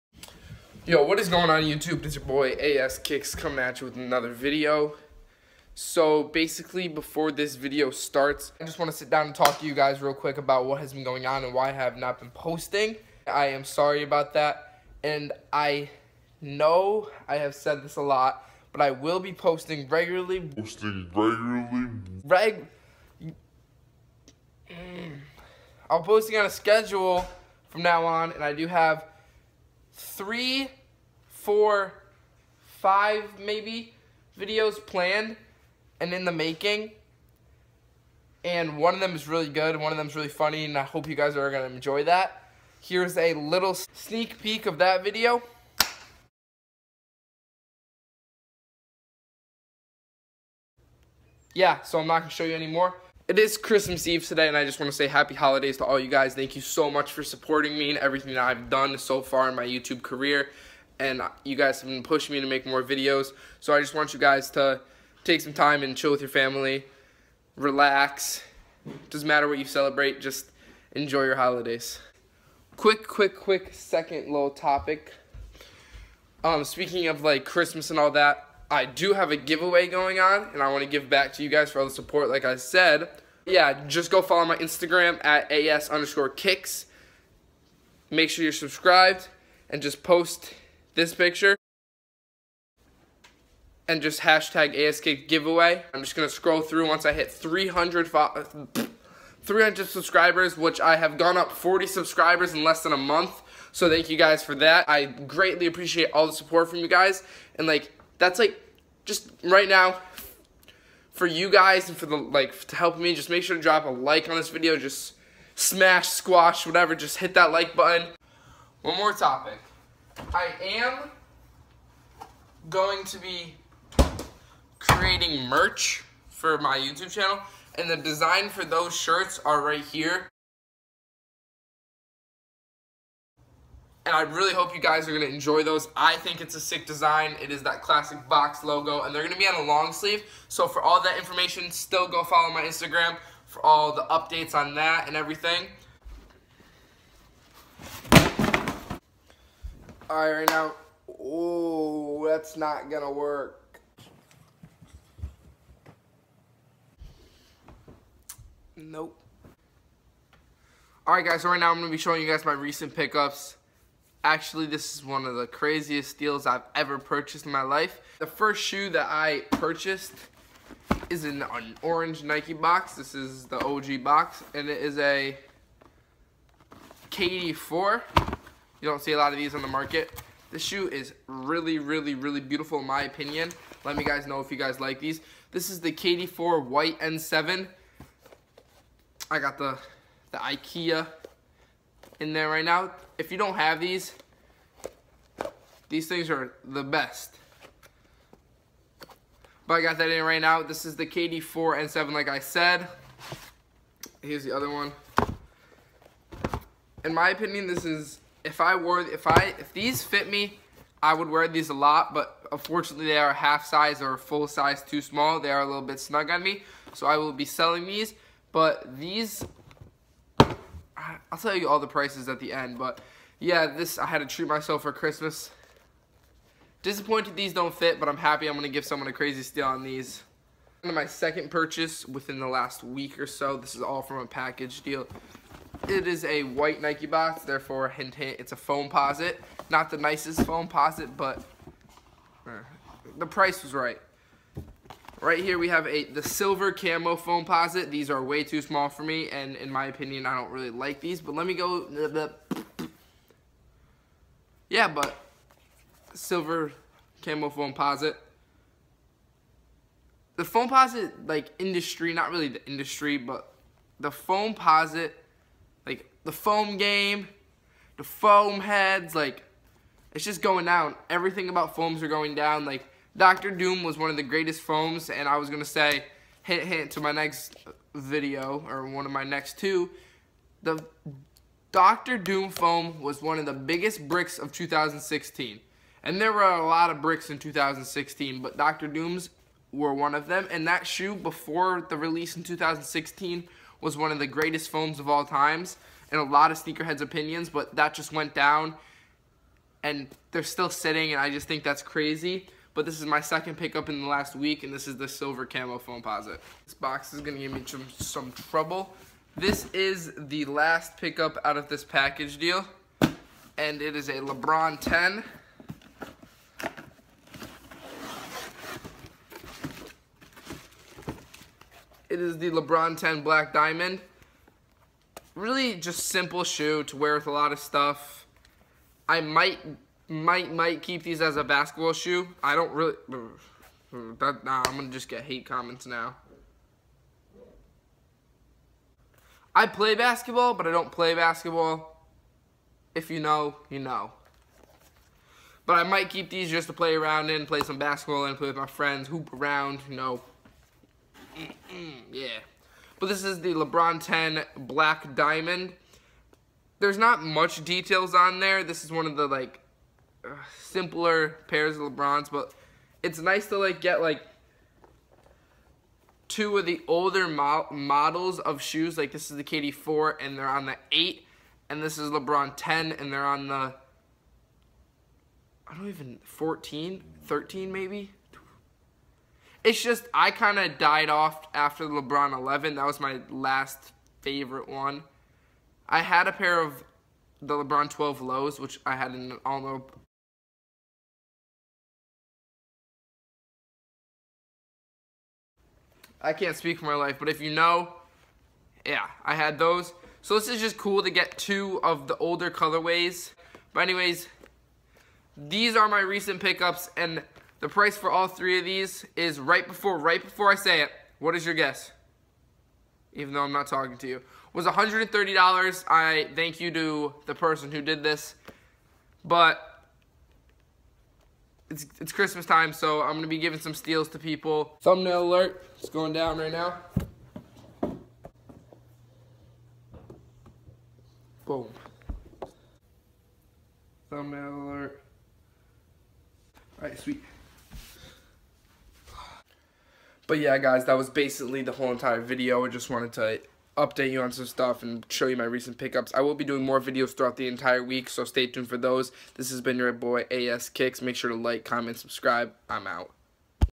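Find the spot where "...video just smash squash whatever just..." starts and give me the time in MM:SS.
01:54.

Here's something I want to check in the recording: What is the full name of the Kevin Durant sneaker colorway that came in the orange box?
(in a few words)
KD4 White N7.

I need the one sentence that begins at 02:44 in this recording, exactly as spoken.
Actually, this is one of the craziest deals I've ever purchased in my life.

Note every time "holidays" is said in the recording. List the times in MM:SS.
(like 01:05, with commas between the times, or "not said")
00:55, 01:11.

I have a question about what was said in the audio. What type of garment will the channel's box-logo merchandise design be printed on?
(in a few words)
long sleeve.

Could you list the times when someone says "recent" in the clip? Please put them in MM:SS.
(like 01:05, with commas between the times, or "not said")
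02:42, 06:46, 07:25.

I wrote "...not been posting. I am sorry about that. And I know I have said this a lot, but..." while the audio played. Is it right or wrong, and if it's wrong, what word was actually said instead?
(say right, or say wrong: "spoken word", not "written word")
right.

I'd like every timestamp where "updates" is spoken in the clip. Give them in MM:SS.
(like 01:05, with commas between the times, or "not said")
02:24, 07:23.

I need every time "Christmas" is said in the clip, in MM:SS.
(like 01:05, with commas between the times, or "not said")
00:53, 01:17, 03:44, 07:02.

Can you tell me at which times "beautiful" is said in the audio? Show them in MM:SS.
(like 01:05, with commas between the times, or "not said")
03:02.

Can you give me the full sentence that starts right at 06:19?
It's just I kind of died off after the LeBron 11.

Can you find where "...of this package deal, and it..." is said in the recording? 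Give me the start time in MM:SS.
05:11.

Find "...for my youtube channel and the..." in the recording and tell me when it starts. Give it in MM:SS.
02:06.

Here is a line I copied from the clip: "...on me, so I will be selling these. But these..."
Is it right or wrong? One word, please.
right.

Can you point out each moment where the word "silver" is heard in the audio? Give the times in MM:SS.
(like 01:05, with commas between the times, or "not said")
04:06, 04:16, 05:05.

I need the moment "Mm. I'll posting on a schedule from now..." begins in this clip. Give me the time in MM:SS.
00:24.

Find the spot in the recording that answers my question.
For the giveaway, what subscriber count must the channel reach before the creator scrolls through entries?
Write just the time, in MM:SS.
01:39.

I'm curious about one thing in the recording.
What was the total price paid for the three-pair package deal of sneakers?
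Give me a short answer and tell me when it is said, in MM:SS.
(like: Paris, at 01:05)
$130, at 06:54.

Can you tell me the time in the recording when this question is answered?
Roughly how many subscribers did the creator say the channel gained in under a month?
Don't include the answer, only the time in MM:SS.
01:41.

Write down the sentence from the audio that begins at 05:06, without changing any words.
This box is gonna give me some, some trouble.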